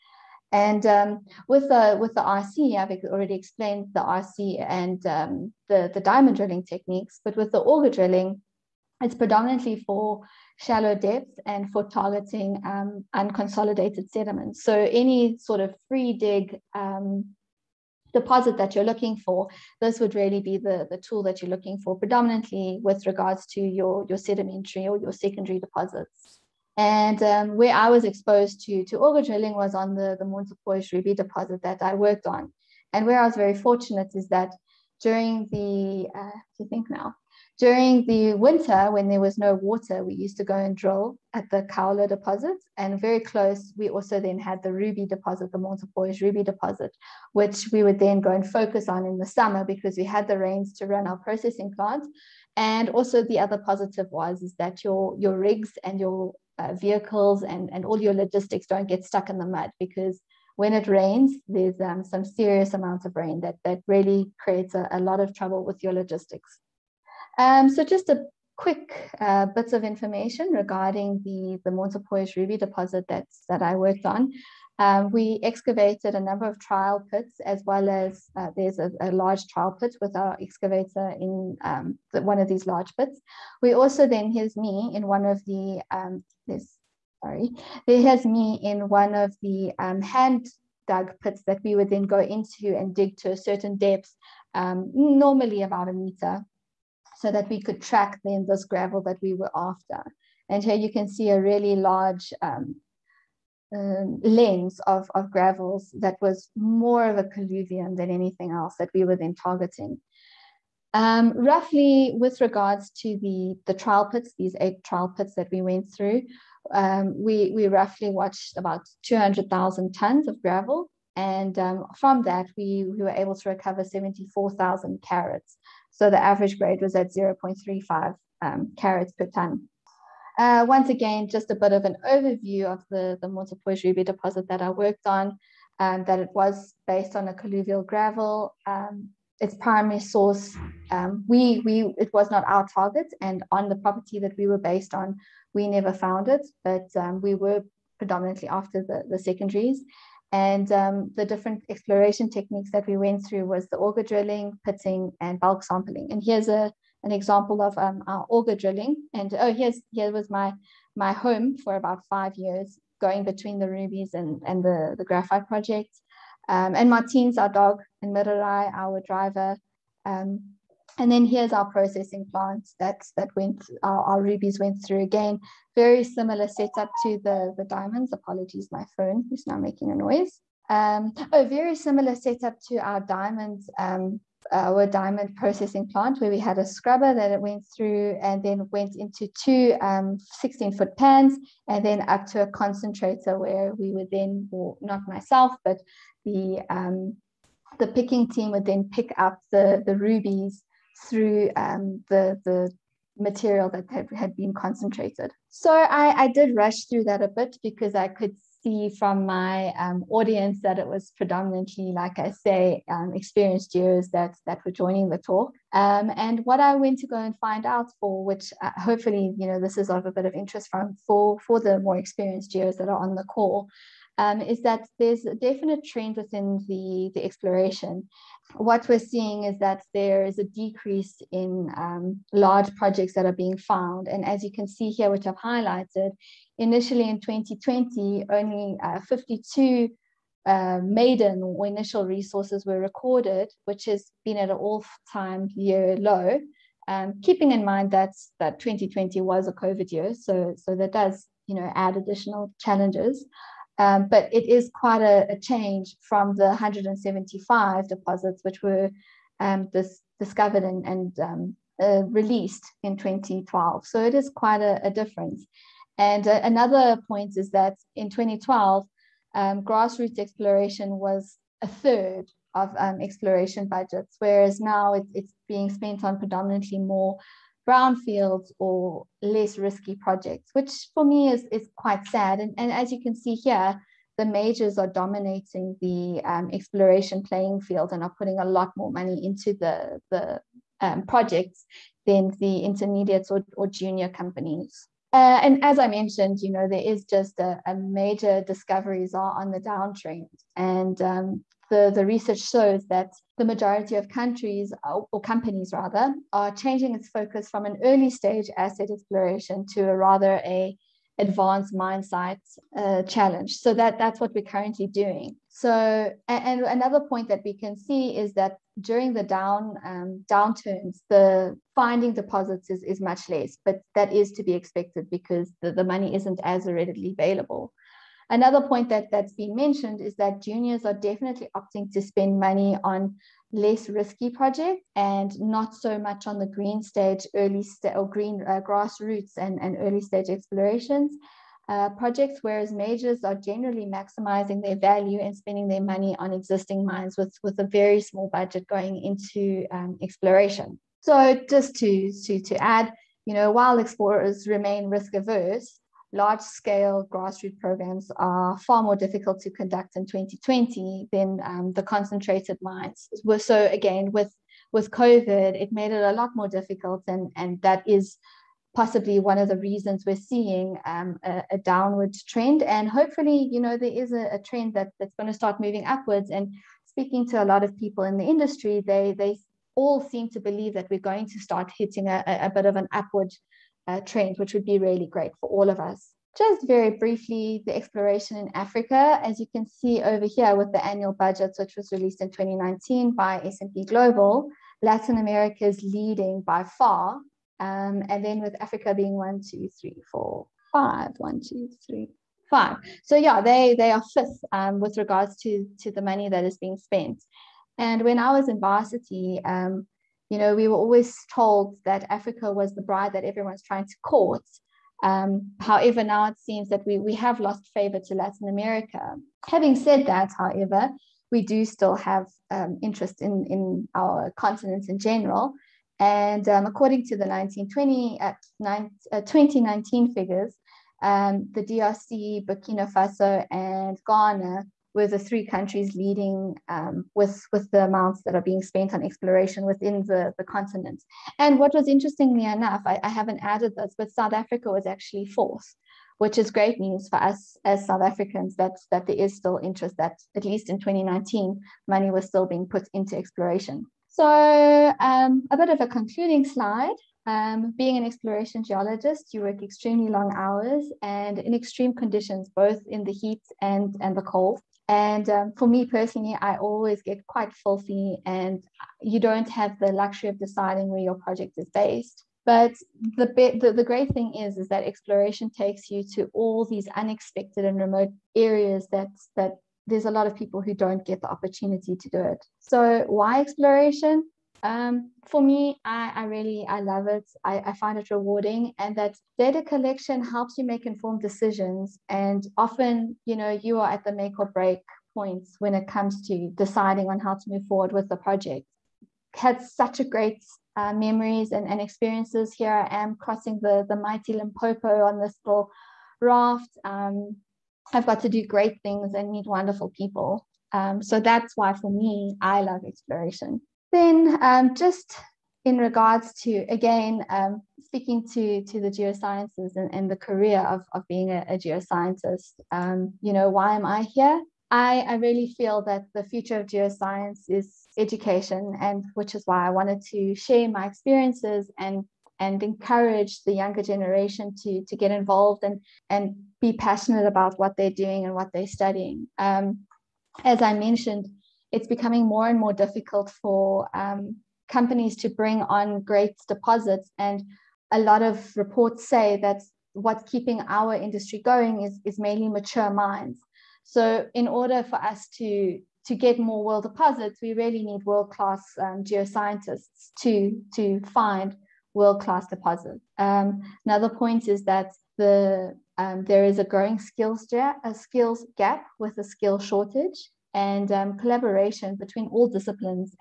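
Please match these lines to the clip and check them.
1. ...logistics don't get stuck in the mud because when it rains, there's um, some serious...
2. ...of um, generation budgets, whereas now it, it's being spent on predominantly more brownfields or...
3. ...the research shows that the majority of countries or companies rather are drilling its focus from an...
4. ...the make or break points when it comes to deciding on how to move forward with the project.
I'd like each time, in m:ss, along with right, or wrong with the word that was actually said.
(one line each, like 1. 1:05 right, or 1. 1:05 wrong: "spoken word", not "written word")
1. 0:58 right
2. 4:32 wrong: "exploration", not "generation"
3. 5:01 wrong: "changing", not "drilling"
4. 8:14 right.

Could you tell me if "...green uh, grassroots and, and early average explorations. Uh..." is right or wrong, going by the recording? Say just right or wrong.
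wrong.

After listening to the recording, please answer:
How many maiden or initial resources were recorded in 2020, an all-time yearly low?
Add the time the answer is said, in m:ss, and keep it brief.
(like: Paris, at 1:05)
52, at 3:59.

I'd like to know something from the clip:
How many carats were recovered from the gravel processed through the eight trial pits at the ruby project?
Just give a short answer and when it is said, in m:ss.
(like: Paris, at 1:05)
74,000, at 2:03.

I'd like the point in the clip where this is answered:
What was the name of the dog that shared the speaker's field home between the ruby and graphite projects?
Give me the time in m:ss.
2:46.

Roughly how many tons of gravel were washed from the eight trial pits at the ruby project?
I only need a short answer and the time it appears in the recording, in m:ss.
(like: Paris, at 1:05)
200,000 tons, at 1:59.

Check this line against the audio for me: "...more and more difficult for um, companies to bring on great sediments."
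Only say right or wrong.
wrong.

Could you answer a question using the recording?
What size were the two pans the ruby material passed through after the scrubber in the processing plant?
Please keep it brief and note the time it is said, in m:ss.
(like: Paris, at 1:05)
16-foot, at 3:09.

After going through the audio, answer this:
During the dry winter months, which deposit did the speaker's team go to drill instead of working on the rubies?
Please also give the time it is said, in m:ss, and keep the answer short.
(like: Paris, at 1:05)
Caula, at 0:41.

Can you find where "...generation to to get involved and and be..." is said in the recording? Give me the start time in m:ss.
8:53.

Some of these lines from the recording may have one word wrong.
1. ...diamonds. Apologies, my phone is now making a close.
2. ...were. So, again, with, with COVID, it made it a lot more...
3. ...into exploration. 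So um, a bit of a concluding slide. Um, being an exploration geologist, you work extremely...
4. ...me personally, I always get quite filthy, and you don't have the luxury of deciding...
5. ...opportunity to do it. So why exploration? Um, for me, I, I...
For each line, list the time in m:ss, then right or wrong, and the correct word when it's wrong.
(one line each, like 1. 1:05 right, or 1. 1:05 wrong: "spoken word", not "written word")
1. 2:57 wrong: "noise", not "close"
2. 6:03 right
3. 7:32 right
4. 7:45 right
5. 8:01 right.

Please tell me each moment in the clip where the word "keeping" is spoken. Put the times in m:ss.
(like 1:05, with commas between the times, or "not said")
4:07, 9:10.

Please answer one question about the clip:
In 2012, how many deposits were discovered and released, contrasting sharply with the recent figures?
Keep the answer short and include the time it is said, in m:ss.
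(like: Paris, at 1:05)
175, at 4:16.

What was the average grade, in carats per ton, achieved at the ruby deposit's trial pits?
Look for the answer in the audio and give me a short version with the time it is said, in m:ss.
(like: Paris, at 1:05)
0.35, at 2:07.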